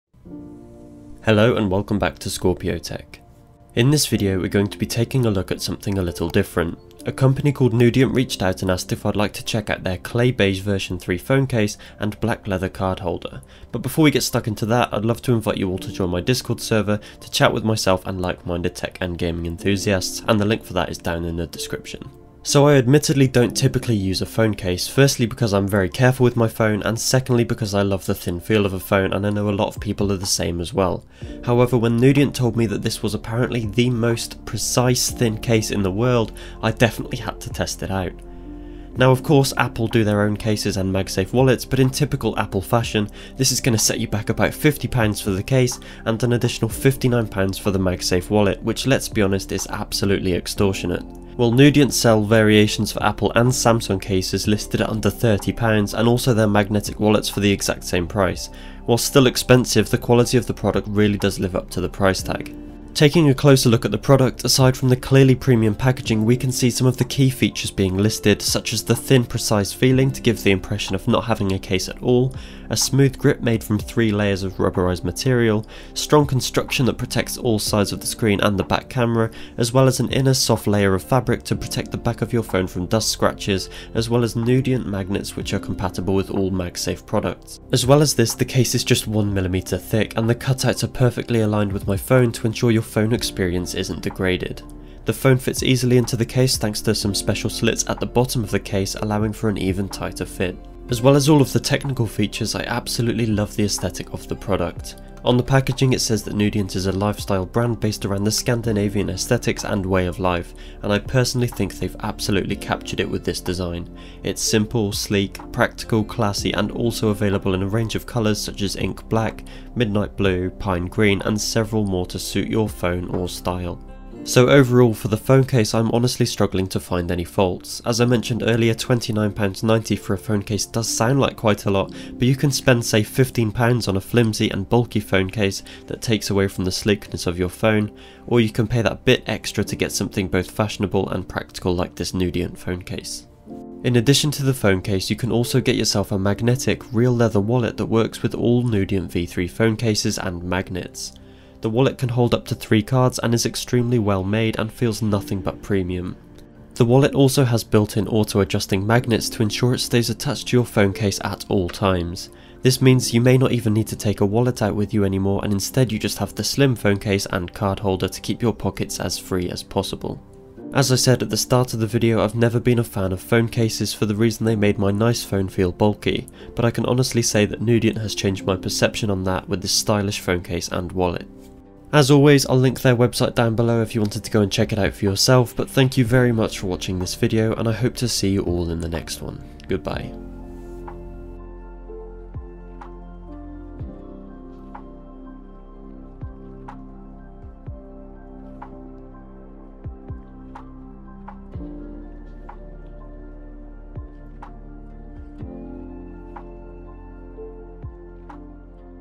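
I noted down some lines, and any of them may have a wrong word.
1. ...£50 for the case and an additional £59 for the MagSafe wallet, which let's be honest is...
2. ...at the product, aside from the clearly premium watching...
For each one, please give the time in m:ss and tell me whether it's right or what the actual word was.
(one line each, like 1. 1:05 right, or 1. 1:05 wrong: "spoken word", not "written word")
1. 0:44 right
2. 1:03 wrong: "packaging", not "watching".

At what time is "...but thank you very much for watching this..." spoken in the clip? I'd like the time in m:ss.
3:05.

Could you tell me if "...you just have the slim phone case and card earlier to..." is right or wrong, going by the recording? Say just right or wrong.
wrong.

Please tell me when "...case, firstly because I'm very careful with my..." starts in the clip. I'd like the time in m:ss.
0:24.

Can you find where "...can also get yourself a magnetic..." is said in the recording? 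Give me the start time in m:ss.
2:25.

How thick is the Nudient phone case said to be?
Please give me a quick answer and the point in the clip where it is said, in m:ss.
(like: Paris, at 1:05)
1mm, at 1:29.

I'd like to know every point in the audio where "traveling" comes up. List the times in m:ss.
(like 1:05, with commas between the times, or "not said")
not said.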